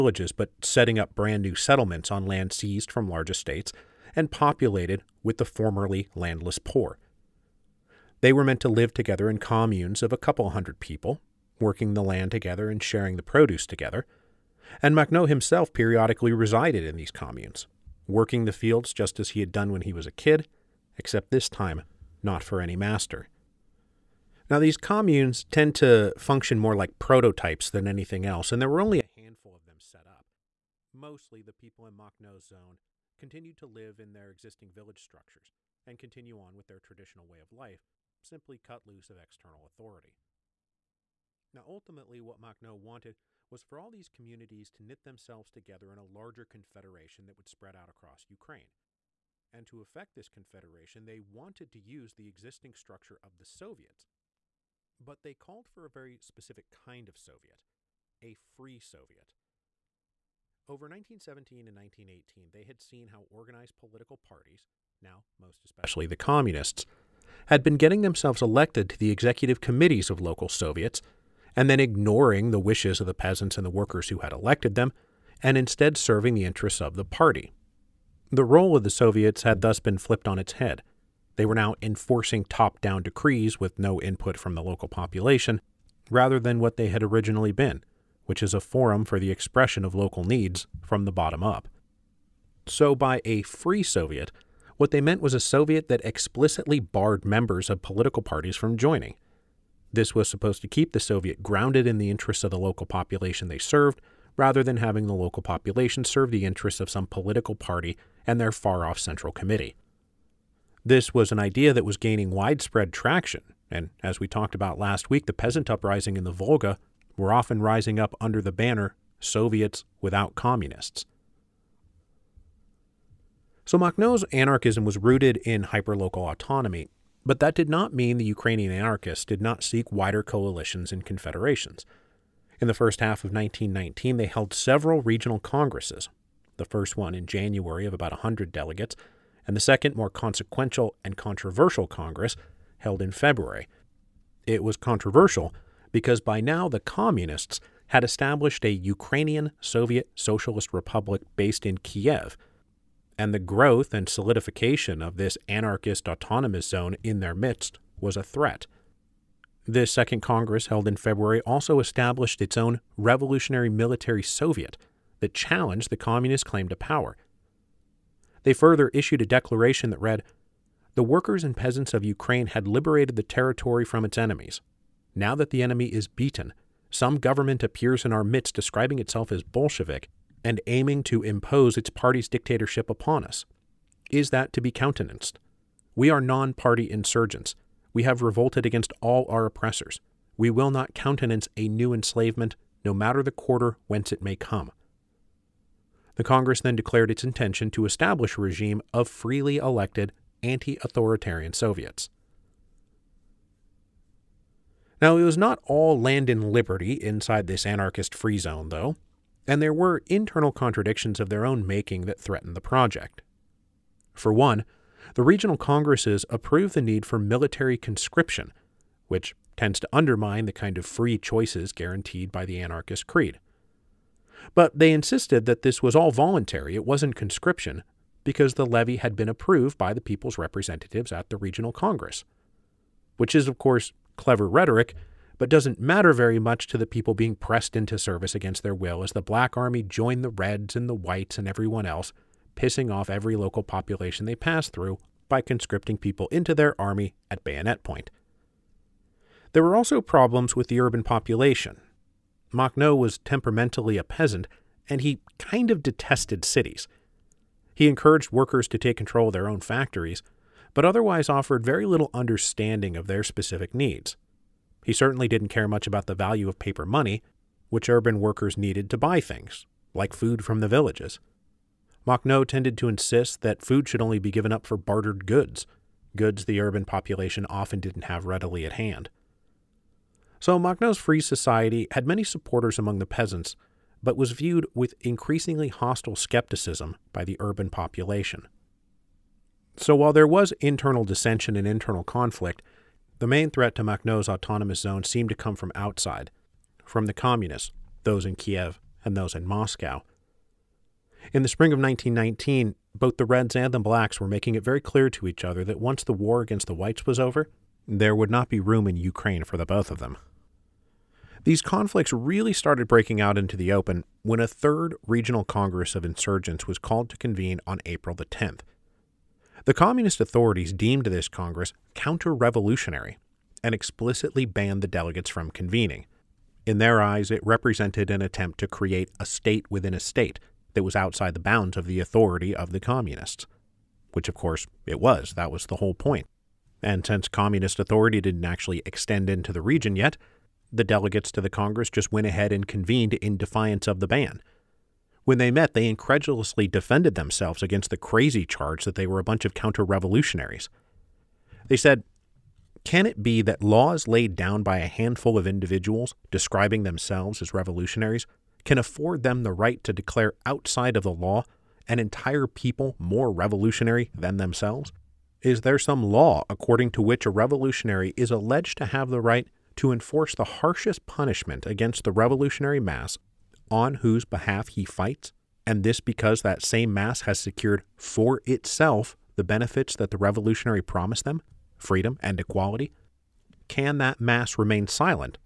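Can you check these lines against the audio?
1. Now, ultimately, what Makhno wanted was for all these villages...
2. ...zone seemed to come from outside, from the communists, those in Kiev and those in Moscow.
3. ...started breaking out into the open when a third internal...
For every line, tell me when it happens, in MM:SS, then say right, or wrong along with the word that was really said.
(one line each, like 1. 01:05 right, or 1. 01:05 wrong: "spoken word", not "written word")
1. 00:41 wrong: "communities", not "villages"
2. 04:54 right
3. 05:12 wrong: "regional", not "internal".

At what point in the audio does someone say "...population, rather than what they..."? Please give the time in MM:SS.
01:24.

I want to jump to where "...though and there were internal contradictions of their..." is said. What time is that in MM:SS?
03:28.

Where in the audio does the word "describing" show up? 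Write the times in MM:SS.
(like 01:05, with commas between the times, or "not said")
02:58, 05:56.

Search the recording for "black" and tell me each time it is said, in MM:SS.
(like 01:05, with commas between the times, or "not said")
03:59, 05:03.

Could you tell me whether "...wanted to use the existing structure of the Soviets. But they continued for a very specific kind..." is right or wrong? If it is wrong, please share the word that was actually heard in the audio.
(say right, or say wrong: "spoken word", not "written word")
wrong: "called", not "continued".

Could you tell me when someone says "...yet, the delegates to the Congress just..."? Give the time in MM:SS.
05:39.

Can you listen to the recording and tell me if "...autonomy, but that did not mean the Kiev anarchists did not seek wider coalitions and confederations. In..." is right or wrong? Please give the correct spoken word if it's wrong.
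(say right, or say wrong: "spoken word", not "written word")
wrong: "Ukrainian", not "Kiev".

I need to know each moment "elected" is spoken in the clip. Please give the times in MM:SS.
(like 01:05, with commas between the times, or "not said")
01:08, 01:14, 03:19.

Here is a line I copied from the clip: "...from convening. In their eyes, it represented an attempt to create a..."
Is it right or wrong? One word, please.
right.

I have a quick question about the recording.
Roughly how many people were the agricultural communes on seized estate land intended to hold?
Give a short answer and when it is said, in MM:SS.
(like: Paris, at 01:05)
A couple hundred, at 00:10.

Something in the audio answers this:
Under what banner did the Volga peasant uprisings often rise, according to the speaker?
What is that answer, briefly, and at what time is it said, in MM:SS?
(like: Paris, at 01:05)
Soviets without communists, at 01:59.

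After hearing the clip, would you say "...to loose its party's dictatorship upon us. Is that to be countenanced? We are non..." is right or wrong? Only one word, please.
wrong.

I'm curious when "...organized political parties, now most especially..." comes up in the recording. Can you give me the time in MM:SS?
01:03.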